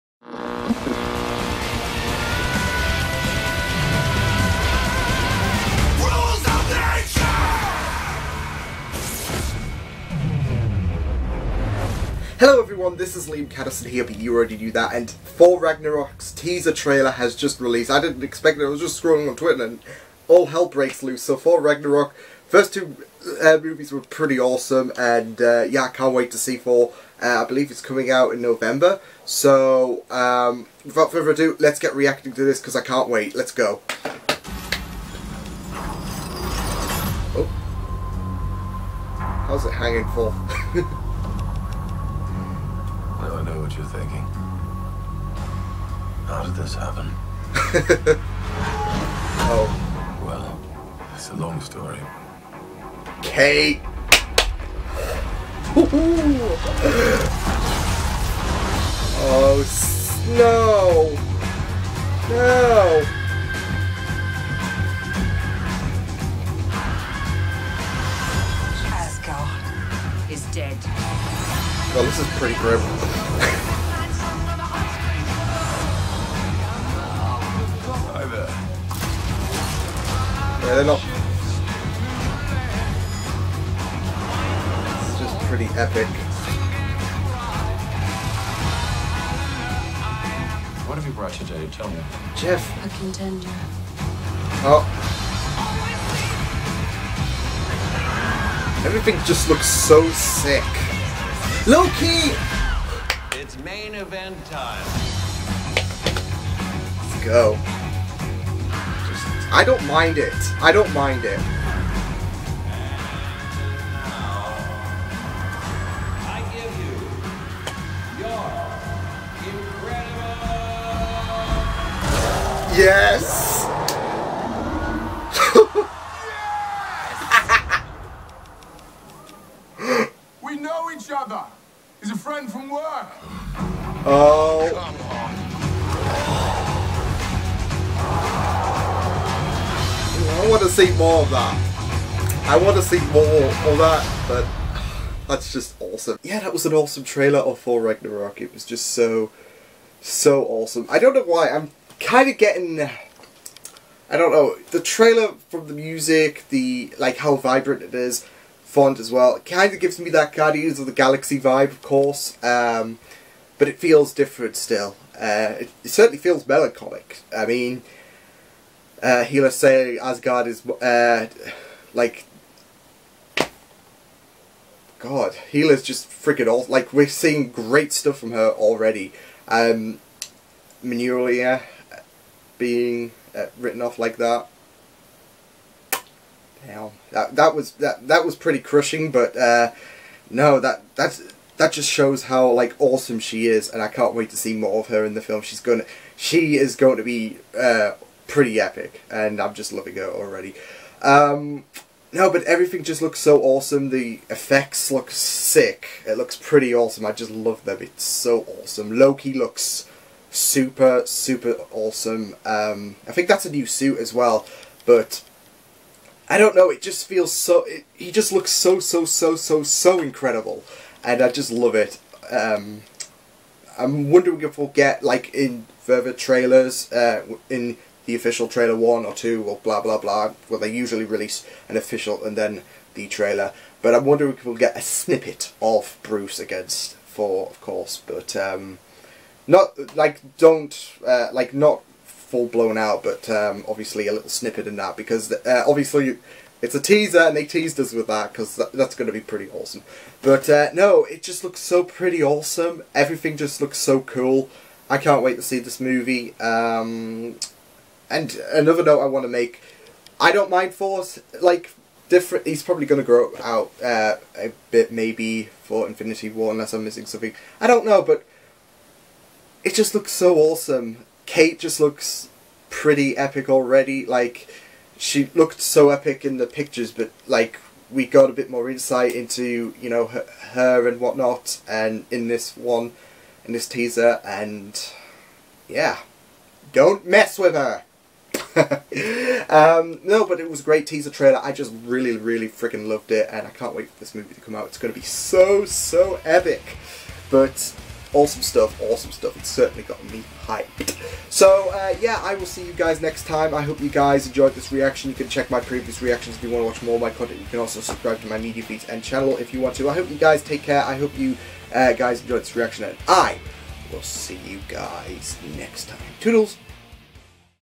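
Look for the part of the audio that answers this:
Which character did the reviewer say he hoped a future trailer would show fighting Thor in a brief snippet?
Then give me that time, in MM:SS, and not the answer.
03:56.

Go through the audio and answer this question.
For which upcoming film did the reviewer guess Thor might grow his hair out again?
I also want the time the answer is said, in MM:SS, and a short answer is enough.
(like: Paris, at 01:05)
Infinity War, at 04:25.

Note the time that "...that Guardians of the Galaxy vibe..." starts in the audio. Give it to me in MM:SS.
02:40.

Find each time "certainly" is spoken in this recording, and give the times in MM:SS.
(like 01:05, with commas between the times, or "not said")
02:45, 04:59.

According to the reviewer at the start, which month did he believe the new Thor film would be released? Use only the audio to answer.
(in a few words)
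November.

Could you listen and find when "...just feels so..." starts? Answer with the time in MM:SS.
03:36.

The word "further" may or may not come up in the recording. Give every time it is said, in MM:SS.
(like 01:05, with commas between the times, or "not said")
00:31, 03:45.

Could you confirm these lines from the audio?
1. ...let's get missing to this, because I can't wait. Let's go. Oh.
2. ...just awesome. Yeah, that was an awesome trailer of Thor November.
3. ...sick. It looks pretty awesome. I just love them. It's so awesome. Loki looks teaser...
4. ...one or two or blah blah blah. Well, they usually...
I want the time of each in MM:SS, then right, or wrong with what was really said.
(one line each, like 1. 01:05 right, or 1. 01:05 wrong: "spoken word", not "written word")
1. 00:31 wrong: "reacting", not "missing"
2. 02:25 wrong: "Ragnarok", not "November"
3. 03:25 wrong: "super", not "teaser"
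4. 03:48 right.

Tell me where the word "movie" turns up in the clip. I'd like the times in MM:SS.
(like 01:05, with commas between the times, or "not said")
00:23, 04:15, 04:54.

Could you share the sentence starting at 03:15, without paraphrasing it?
She's gonna, she is going to be uh, pretty epic, and I'm just loving her already.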